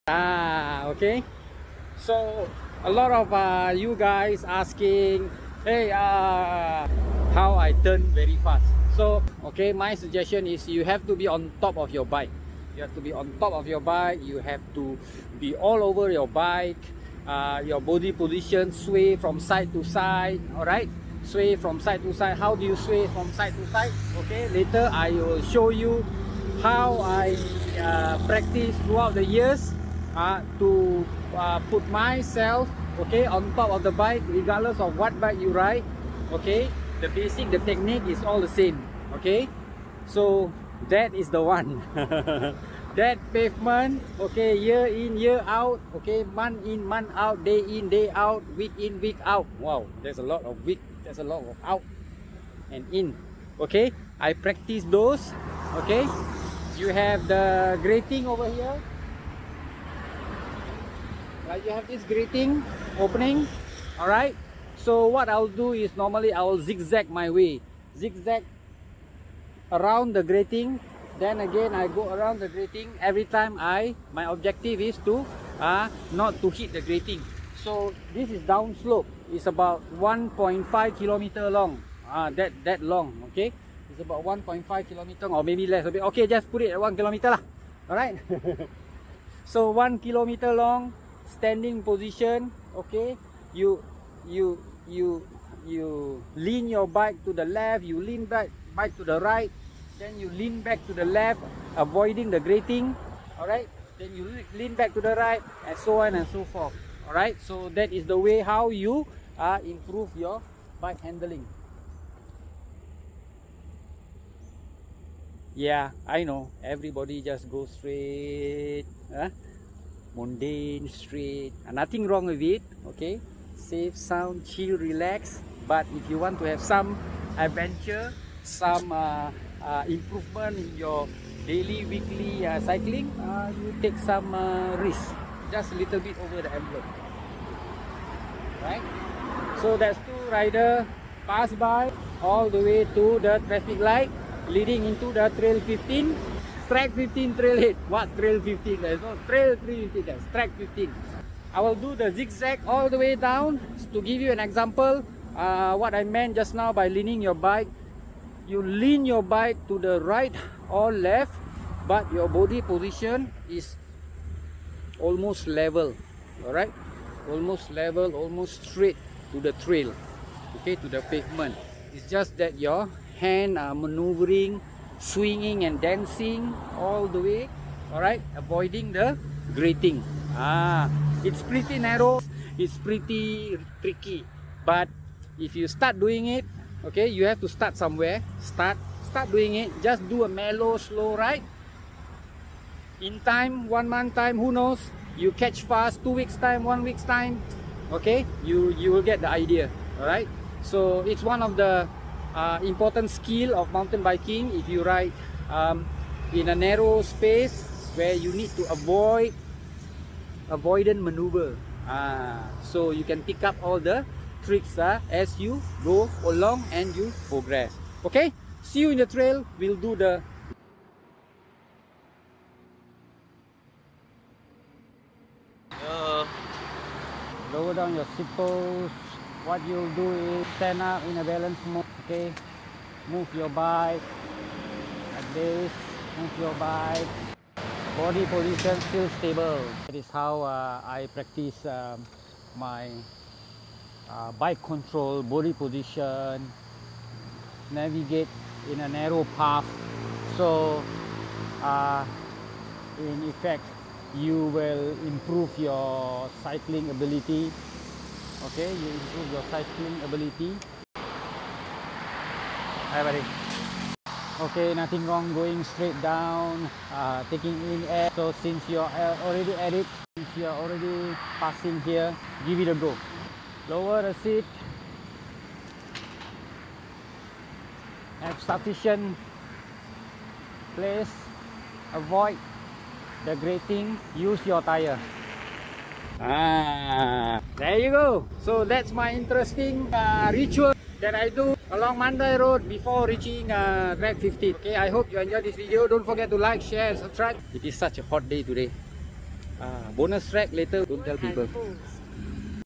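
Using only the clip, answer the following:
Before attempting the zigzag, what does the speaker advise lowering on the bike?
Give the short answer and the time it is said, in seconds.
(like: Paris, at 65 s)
the seat, at 273 s.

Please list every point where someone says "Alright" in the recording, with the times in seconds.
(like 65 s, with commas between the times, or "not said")
63 s, 87 s.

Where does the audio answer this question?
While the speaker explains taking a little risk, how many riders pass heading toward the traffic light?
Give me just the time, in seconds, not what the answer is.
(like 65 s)
140 s.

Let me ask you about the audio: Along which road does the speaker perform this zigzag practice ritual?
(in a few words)
Mandai Road.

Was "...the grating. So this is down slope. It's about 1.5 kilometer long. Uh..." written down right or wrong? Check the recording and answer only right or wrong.
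right.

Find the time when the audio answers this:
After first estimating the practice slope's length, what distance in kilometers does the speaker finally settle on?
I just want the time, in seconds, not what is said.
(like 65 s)
86 s.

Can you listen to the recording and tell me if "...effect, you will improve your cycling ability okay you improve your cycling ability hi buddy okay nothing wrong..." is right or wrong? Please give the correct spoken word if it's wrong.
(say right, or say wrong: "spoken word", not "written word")
right.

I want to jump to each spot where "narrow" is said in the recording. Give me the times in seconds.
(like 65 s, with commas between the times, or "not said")
181 s, 206 s, 248 s.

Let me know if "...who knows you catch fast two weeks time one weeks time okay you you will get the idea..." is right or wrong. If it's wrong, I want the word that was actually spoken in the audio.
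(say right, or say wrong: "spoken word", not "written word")
right.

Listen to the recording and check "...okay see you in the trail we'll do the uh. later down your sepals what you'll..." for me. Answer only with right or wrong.
wrong.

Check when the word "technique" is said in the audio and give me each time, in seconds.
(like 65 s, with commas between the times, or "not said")
37 s.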